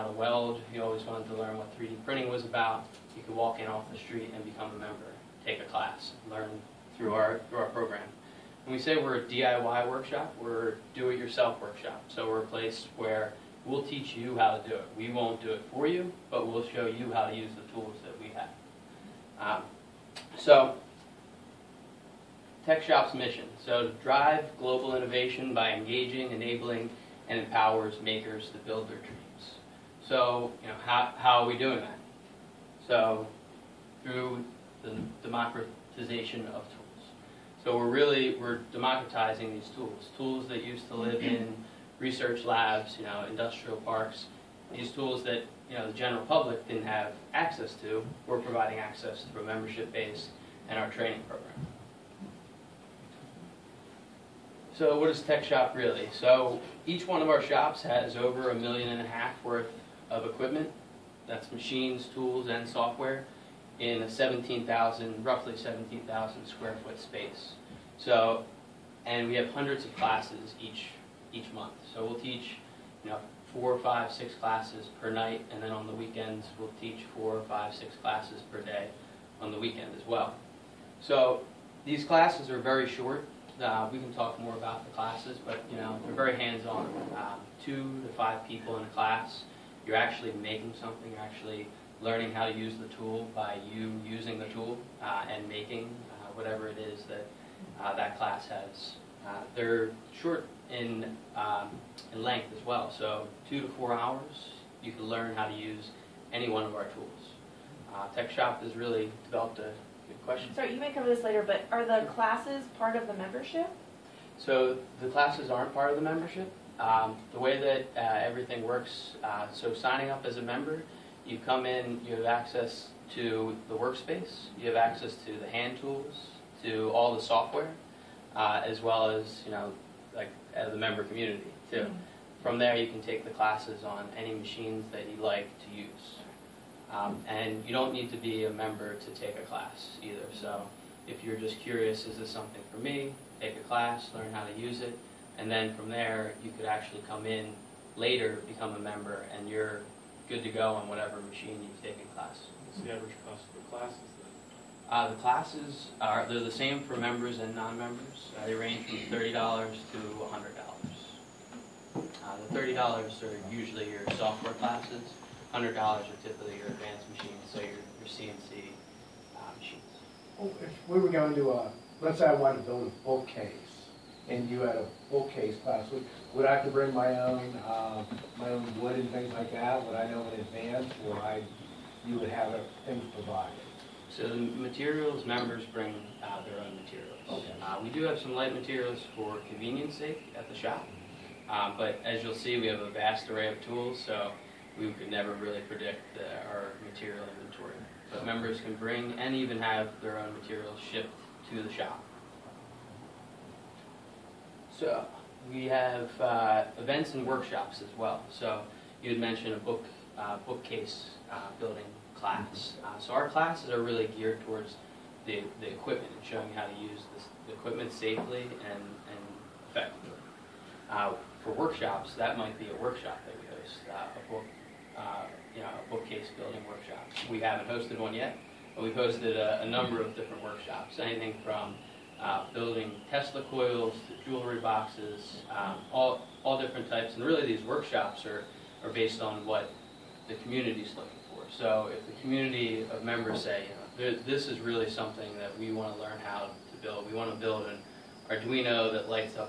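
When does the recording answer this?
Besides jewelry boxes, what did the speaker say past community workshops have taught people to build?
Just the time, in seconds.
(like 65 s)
233 s.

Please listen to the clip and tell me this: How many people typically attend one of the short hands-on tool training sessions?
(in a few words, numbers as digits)
2 to 5.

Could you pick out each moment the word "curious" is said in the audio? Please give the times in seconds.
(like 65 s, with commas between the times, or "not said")
141 s.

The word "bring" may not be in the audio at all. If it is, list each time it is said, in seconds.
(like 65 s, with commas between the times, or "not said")
176 s, 185 s, 198 s.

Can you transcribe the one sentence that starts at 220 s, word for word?
Uh, for workshops, that might be a workshop that we host, uh, a book, uh, you know, a bookcase building workshop.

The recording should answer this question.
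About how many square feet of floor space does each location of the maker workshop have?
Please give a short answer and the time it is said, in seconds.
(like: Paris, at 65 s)
17,000 square feet, at 65 s.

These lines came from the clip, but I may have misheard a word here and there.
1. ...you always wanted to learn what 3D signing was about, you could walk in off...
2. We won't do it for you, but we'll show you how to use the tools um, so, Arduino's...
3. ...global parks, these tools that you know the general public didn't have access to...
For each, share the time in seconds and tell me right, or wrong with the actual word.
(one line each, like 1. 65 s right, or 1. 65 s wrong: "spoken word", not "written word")
1. 0 s wrong: "printing", not "signing"
2. 14 s wrong: "TechShop", not "Arduino"
3. 43 s wrong: "industrial", not "global".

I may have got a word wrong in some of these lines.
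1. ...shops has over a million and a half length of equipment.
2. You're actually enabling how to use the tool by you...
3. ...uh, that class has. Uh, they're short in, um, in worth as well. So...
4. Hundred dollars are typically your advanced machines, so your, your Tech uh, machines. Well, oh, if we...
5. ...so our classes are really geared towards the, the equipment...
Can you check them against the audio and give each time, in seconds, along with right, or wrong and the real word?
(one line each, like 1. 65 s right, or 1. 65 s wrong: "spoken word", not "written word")
1. 57 s wrong: "worth", not "length"
2. 91 s wrong: "learning", not "enabling"
3. 97 s wrong: "length", not "worth"
4. 165 s wrong: "CNC", not "Tech"
5. 212 s right.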